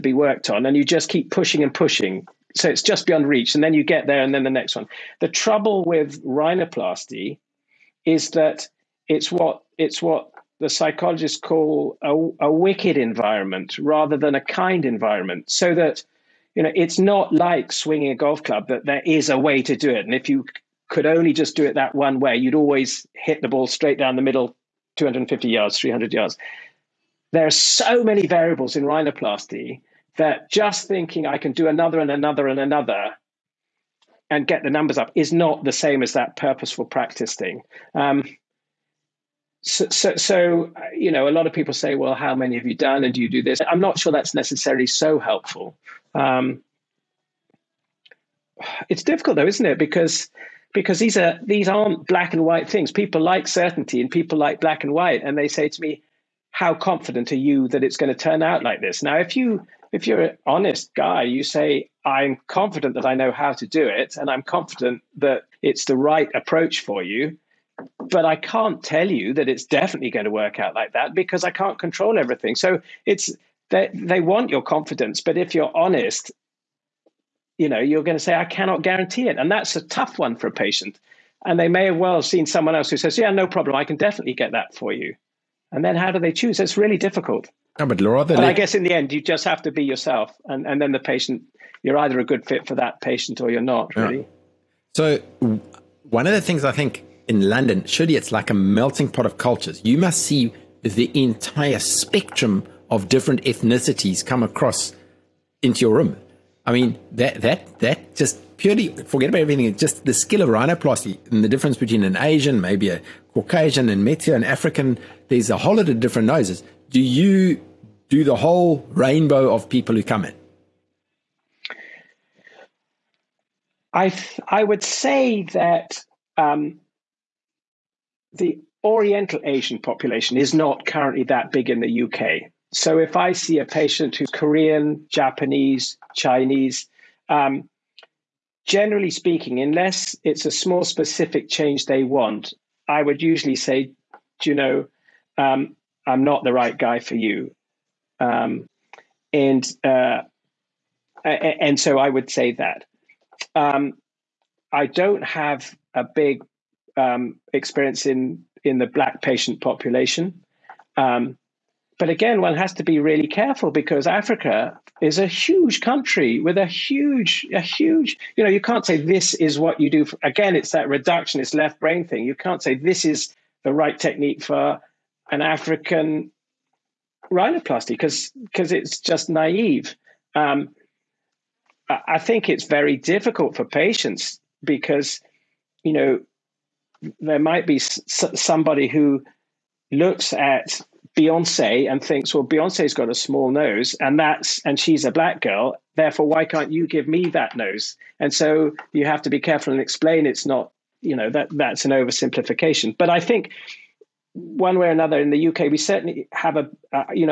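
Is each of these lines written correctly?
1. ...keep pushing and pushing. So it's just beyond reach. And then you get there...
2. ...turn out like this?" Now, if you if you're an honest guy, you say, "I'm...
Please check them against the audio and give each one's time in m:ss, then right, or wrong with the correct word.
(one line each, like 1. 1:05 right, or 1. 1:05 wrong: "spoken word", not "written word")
1. 0:01 right
2. 0:58 right.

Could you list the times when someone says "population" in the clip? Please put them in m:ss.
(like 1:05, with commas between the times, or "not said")
2:09, 2:39.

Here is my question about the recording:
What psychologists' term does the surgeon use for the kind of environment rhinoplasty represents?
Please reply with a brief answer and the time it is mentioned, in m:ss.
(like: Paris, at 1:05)
wicked environment, at 0:12.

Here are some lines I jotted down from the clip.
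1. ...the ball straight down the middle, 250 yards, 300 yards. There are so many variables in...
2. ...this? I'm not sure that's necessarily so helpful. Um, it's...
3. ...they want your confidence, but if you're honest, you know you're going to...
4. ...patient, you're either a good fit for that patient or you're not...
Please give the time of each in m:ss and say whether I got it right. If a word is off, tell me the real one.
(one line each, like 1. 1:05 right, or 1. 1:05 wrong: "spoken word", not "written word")
1. 0:23 right
2. 0:43 right
3. 1:13 right
4. 1:30 right.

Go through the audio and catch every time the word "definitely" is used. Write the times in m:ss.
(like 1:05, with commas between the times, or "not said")
1:09, 1:23.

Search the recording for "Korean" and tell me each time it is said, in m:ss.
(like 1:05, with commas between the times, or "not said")
2:14.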